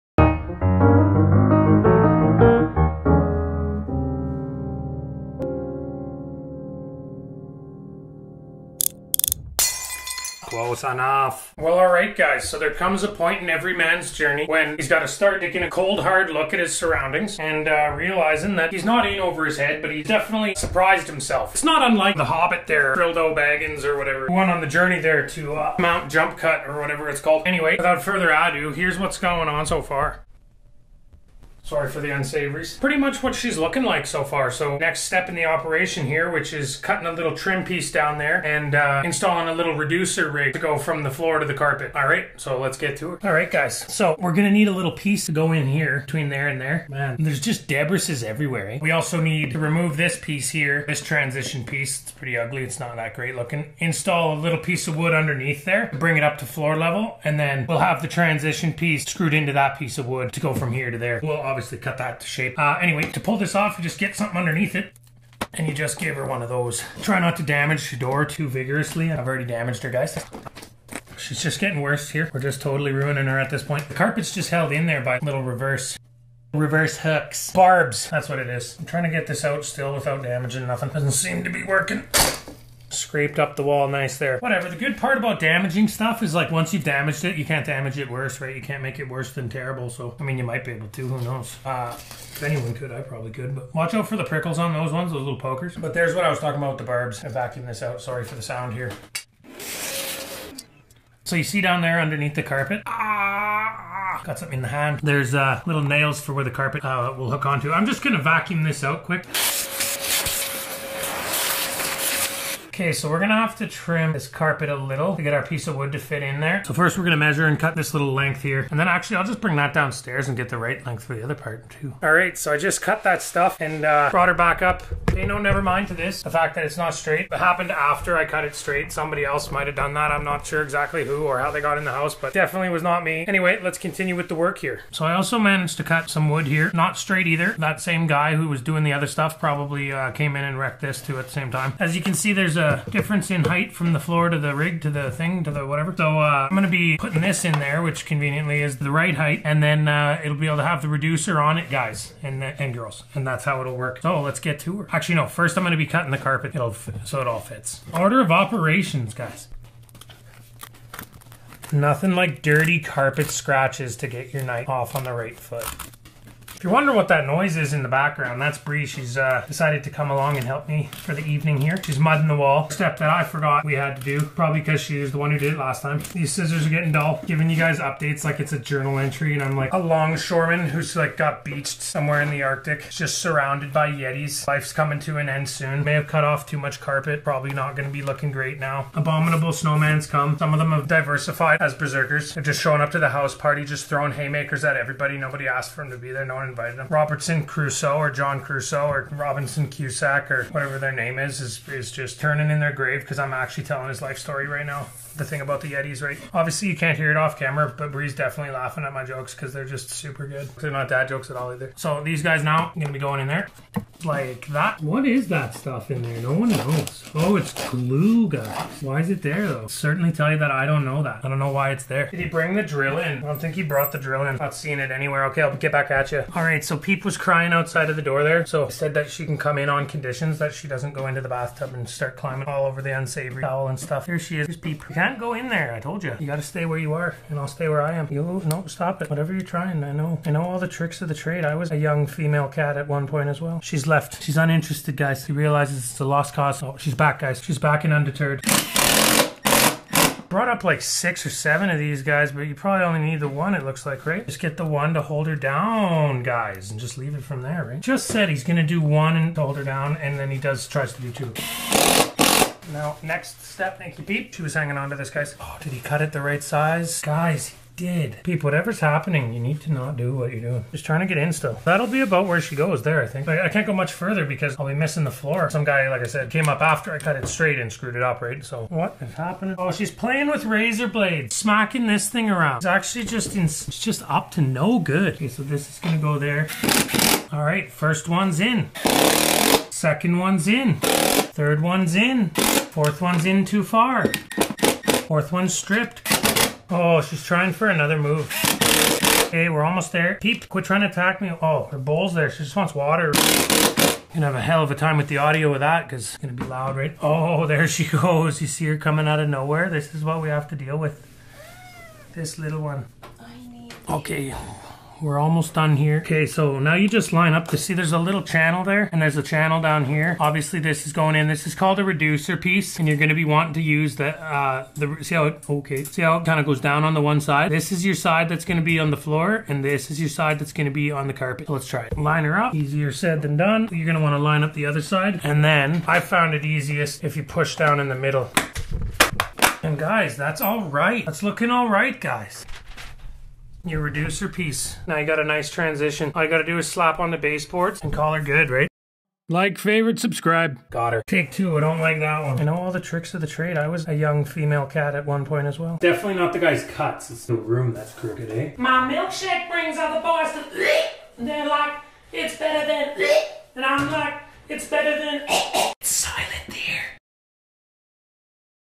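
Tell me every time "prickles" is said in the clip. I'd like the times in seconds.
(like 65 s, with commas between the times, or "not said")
94 s.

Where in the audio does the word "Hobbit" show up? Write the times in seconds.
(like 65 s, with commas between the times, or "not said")
22 s.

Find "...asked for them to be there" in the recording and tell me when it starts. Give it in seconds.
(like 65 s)
195 s.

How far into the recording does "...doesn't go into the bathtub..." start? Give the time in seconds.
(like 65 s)
230 s.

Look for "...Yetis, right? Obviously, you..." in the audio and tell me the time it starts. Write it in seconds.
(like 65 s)
205 s.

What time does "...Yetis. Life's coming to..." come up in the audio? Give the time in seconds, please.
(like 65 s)
183 s.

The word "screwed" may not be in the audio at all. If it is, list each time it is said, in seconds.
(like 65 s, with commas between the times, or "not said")
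59 s, 277 s.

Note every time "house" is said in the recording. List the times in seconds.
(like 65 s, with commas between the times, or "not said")
131 s, 193 s.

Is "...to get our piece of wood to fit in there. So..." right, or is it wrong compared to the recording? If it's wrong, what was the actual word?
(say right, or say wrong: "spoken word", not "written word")
right.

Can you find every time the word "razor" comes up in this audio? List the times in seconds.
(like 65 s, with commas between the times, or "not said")
280 s.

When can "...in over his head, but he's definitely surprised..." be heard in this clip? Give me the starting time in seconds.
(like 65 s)
19 s.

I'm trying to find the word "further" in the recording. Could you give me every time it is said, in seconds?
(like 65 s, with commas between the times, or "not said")
28 s, 273 s.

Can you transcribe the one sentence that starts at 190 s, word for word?
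Some of them have diversified as berserkers.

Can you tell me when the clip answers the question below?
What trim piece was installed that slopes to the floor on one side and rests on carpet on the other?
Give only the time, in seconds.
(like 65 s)
321 s.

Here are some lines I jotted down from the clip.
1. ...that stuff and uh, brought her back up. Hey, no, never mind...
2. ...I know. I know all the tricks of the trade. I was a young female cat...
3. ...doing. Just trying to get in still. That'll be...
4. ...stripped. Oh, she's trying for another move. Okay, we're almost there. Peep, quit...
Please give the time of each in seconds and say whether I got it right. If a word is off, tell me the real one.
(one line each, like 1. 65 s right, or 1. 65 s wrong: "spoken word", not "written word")
1. 123 s right
2. 239 s right
3. 270 s right
4. 295 s right.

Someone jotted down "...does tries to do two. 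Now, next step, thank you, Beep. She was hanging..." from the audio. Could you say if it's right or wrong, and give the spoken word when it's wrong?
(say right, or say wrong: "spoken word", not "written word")
right.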